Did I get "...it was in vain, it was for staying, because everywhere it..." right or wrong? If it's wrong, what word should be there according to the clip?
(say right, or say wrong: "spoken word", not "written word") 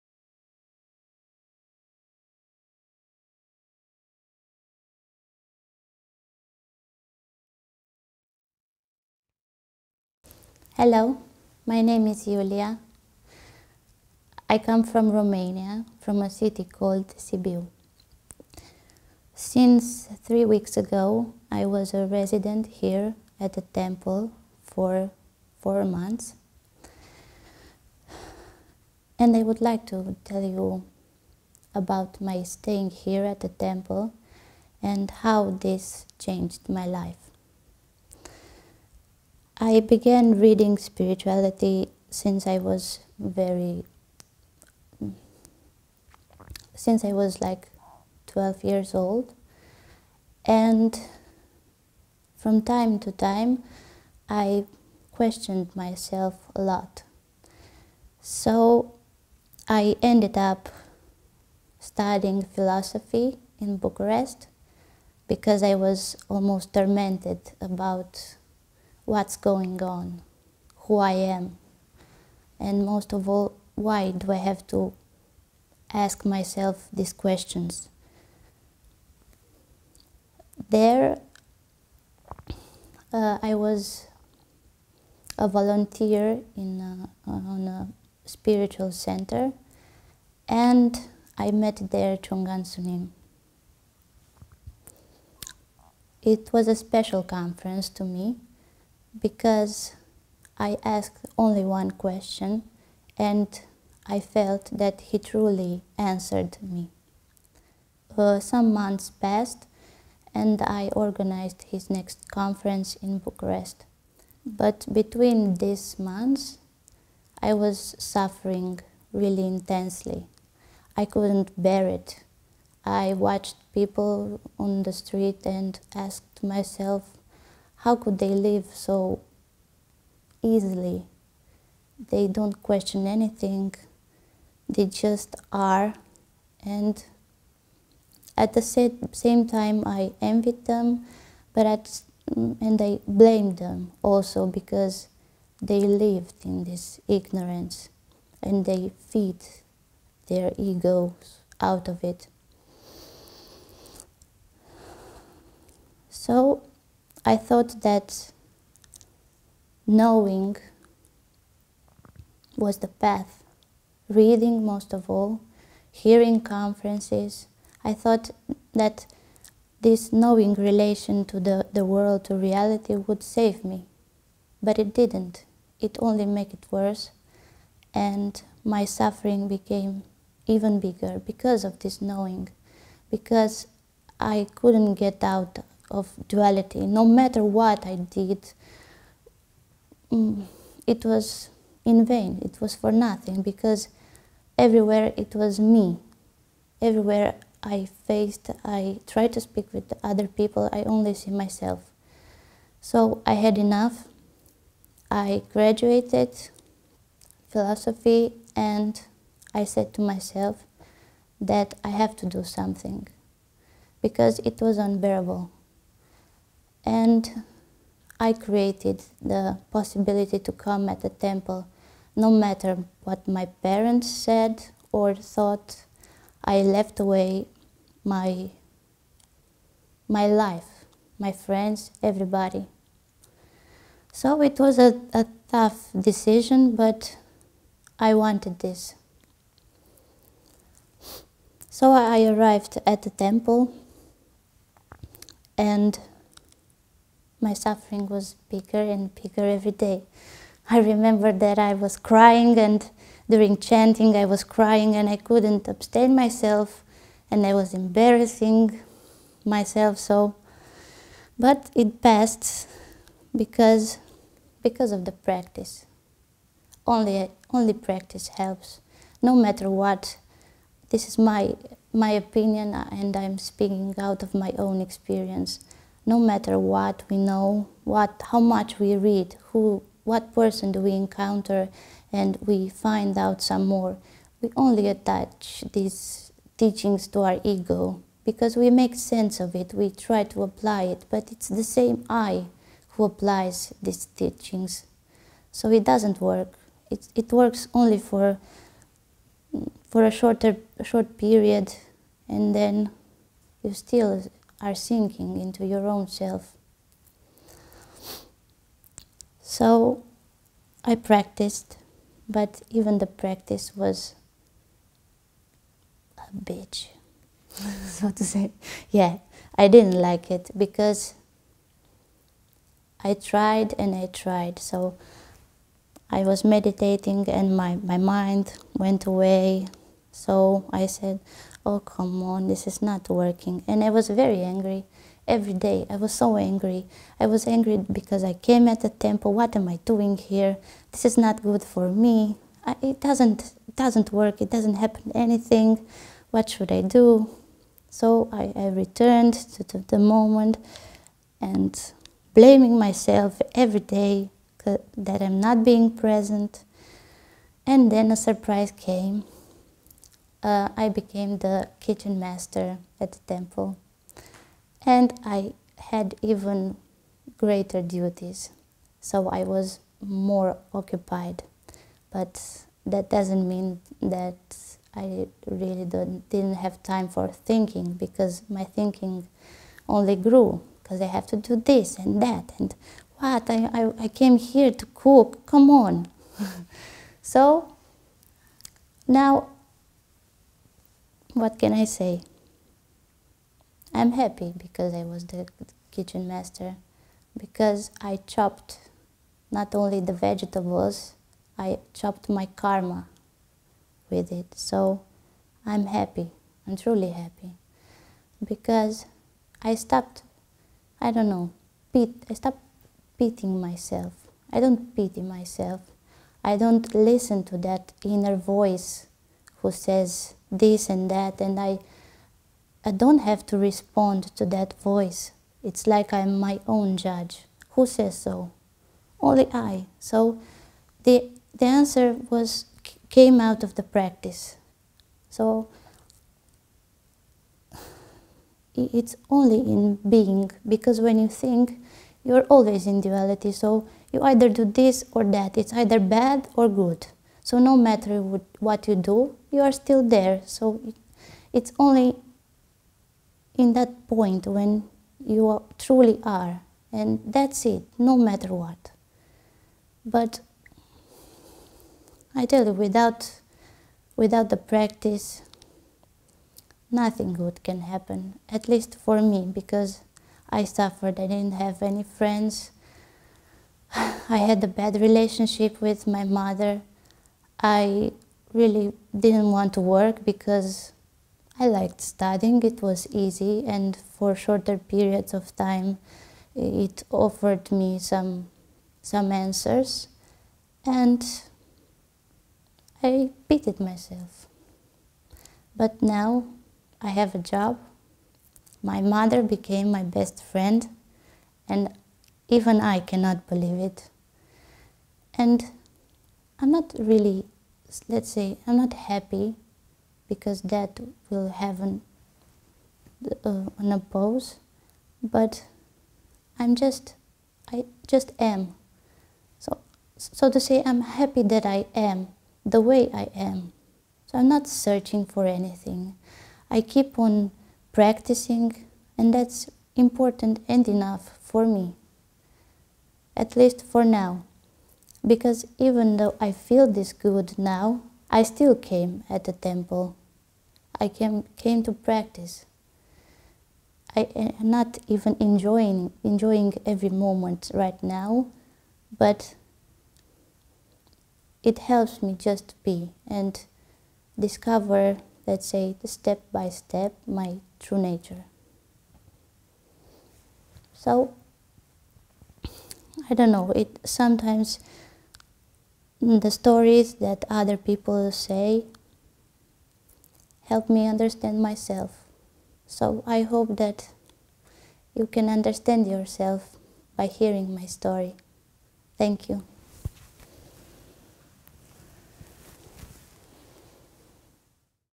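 wrong: "nothing", not "staying".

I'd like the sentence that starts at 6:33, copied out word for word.
I'm happy because I was the kitchen master, because I chopped not only the vegetables, I chopped my karma with it.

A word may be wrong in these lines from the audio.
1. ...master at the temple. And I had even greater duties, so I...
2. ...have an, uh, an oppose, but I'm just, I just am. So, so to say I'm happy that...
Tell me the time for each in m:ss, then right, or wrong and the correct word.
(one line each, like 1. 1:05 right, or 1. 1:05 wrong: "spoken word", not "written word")
1. 6:02 right
2. 8:31 right.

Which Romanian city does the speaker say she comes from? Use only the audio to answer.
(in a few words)
Sibiu.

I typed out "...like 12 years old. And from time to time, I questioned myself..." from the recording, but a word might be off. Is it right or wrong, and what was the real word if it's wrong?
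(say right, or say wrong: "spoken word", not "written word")
right.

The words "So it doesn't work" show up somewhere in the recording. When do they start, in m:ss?
4:55.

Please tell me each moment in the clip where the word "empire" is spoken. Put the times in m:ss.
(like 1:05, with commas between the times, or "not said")
not said.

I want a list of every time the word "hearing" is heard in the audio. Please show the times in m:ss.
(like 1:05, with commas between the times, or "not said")
2:45, 9:37.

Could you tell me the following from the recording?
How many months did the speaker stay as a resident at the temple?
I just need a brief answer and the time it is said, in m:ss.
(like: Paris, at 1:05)
4, at 0:25.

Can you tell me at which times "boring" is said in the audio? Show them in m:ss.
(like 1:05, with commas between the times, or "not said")
not said.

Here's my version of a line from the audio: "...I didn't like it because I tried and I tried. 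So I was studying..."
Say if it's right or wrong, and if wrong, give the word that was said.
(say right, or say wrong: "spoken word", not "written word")
wrong: "meditating", not "studying".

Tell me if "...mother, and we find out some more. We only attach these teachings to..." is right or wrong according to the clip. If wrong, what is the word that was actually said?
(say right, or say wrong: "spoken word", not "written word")
wrong: "encounter", not "mother".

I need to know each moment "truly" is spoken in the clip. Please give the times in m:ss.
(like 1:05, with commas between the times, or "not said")
1:45, 6:46, 7:35.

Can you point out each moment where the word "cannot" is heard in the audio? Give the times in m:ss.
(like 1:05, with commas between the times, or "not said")
8:22.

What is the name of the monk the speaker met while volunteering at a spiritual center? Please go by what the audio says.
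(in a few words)
Chong An Sunim.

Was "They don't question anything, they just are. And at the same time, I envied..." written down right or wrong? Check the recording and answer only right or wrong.
right.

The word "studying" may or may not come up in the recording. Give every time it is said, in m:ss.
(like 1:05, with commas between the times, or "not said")
1:01, 8:02.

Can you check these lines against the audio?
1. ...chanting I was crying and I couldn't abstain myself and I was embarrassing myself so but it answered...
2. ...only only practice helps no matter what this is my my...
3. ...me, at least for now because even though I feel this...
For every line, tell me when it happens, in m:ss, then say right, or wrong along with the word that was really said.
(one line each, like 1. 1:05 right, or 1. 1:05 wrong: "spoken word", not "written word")
1. 4:13 wrong: "passed", not "answered"
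2. 4:26 right
3. 8:51 right.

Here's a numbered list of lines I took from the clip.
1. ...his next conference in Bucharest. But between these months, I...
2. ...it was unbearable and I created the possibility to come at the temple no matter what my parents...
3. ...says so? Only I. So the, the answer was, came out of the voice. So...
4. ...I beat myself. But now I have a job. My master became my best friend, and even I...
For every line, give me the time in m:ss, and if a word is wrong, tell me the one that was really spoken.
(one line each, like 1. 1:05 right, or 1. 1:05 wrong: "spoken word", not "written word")
1. 1:51 right
2. 3:34 right
3. 7:07 wrong: "practice", not "voice"
4. 8:13 wrong: "mother", not "master".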